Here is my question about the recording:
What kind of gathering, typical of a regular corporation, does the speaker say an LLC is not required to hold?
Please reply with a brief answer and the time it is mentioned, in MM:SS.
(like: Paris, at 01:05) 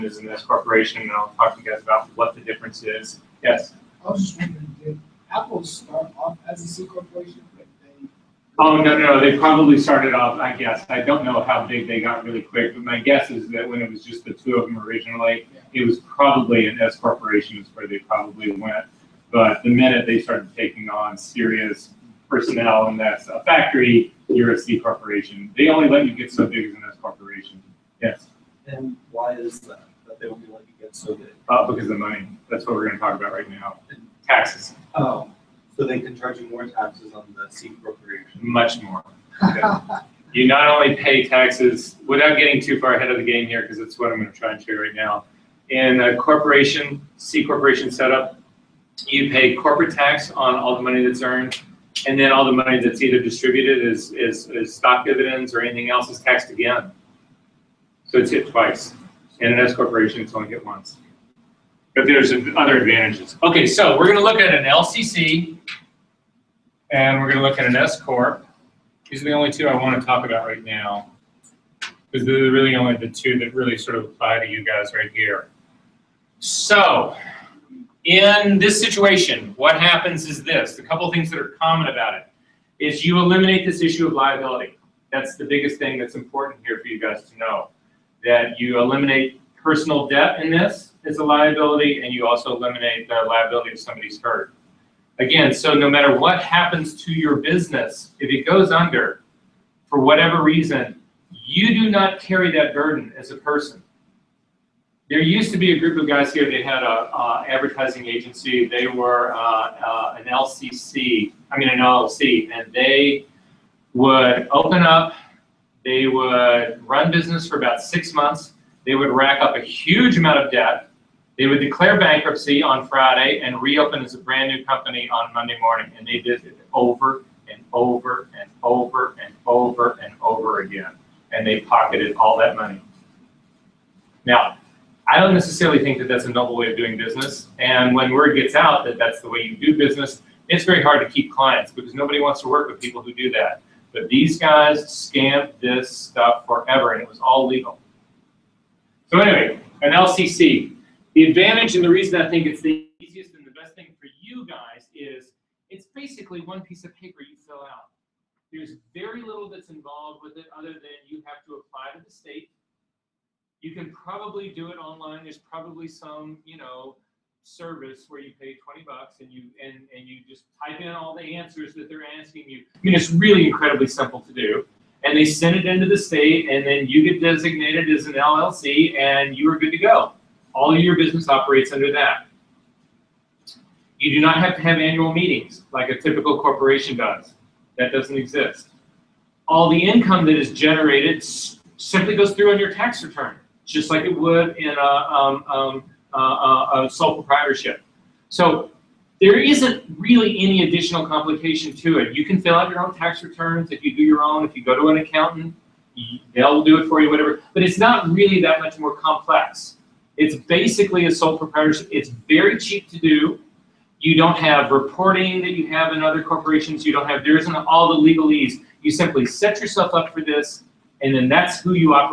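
annual meetings, at 03:04.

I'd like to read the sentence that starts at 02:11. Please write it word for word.
And they pocketed all that money.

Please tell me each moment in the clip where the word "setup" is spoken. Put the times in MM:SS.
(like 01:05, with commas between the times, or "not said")
00:47.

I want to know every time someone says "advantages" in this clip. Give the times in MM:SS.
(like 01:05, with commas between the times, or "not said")
01:02, 02:31.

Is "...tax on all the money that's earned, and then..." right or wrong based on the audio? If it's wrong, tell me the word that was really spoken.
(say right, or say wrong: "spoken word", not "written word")
right.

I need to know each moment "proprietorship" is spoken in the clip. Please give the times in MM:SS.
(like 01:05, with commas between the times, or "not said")
03:17, 03:31.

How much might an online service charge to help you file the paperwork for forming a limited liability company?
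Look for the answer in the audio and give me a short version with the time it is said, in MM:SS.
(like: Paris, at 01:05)
20 bucks, at 02:48.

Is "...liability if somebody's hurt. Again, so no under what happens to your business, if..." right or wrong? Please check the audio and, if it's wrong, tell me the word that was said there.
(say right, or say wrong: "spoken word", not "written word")
wrong: "matter", not "under".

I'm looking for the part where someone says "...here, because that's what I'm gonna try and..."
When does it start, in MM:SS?
00:43.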